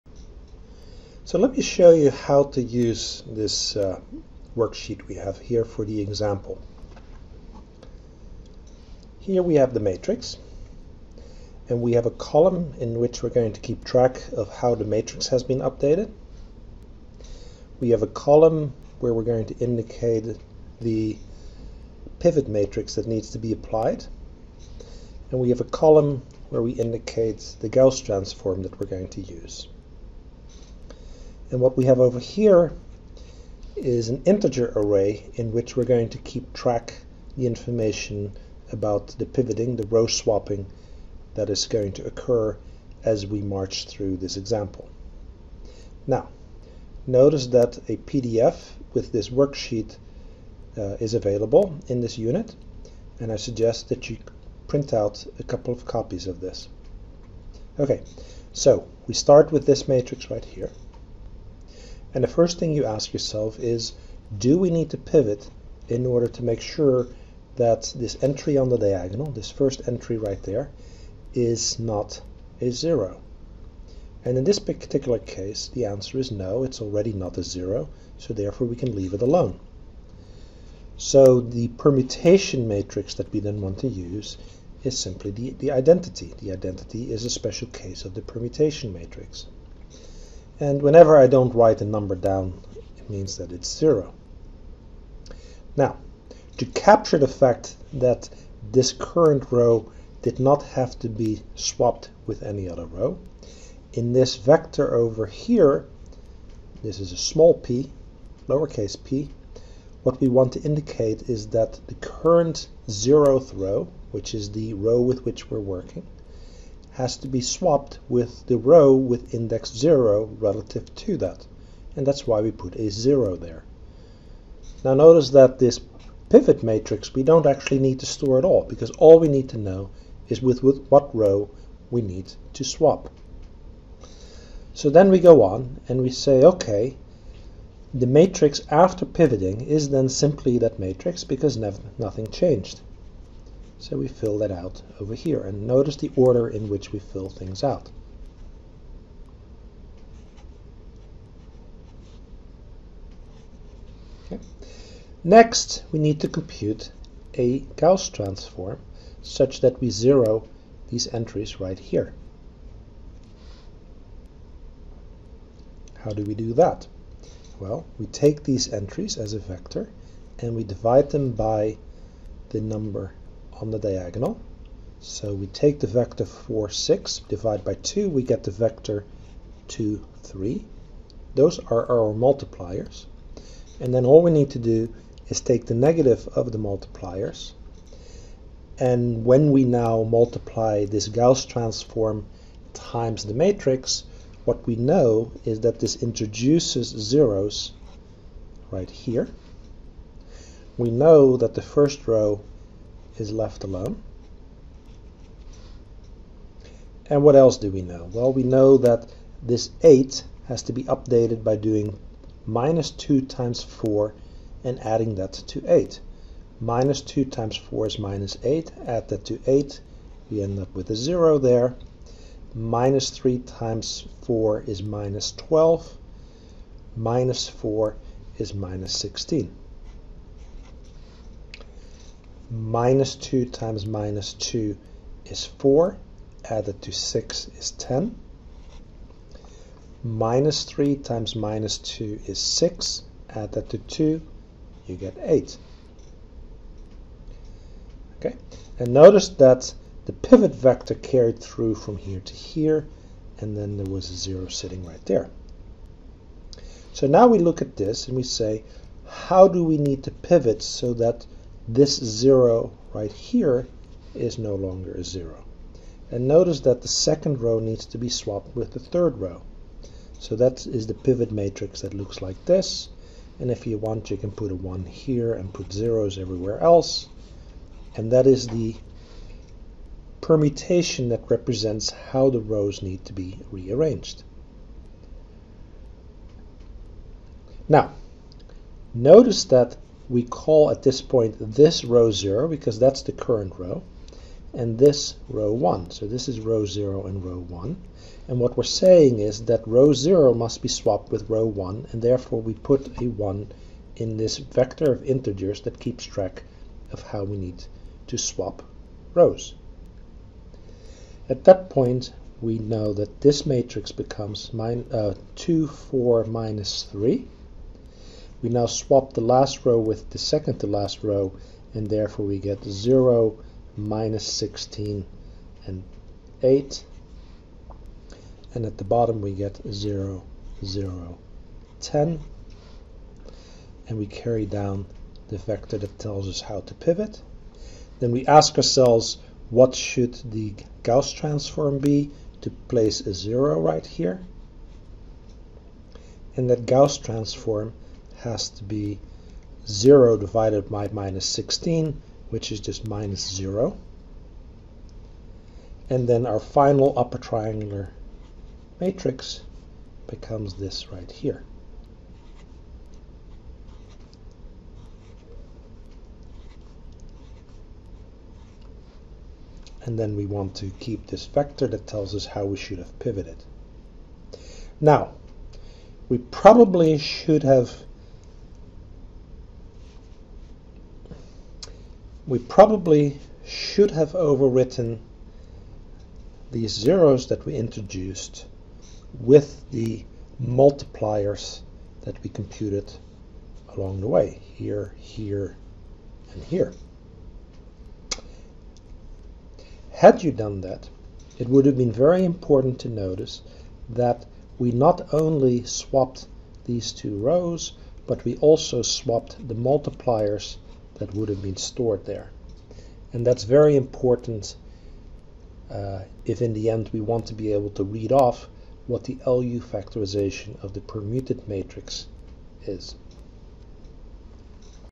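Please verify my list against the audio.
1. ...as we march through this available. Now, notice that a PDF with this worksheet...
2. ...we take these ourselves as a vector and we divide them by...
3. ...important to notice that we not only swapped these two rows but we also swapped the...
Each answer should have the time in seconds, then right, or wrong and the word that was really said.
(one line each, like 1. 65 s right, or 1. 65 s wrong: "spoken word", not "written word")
1. 43 s wrong: "example", not "available"
2. 167 s wrong: "entries", not "ourselves"
3. 402 s right.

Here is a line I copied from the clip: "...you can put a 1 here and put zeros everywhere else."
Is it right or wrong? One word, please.
right.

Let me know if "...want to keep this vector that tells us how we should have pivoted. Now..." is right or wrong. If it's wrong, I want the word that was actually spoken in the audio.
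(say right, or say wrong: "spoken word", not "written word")
right.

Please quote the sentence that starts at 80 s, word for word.
So the permutation matrix that we then want to use is simply the, the identity.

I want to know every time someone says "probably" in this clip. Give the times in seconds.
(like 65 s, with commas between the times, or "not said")
376 s, 382 s.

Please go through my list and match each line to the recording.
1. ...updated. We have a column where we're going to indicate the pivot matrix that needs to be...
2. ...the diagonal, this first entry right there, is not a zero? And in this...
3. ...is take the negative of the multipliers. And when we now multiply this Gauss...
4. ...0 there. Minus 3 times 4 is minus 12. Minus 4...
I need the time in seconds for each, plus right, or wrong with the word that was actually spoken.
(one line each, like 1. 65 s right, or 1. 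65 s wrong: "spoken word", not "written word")
1. 15 s right
2. 68 s right
3. 185 s right
4. 220 s right.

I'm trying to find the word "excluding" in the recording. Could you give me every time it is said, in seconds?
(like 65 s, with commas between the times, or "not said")
not said.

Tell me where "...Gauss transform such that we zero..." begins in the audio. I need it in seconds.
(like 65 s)
157 s.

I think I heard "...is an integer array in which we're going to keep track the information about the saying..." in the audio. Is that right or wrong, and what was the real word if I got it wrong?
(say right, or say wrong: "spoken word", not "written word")
wrong: "pivoting", not "saying".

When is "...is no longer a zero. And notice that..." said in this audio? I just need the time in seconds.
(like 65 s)
264 s.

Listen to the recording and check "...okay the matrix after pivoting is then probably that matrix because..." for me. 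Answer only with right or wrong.
wrong.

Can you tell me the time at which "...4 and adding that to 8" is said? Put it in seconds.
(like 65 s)
213 s.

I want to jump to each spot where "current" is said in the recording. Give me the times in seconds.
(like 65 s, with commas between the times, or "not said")
98 s, 111 s, 293 s.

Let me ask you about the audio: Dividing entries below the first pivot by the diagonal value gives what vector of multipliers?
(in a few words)
2, 3.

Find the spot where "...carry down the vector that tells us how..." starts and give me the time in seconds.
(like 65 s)
334 s.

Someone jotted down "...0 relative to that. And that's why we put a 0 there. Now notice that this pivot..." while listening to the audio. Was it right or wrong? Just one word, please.
right.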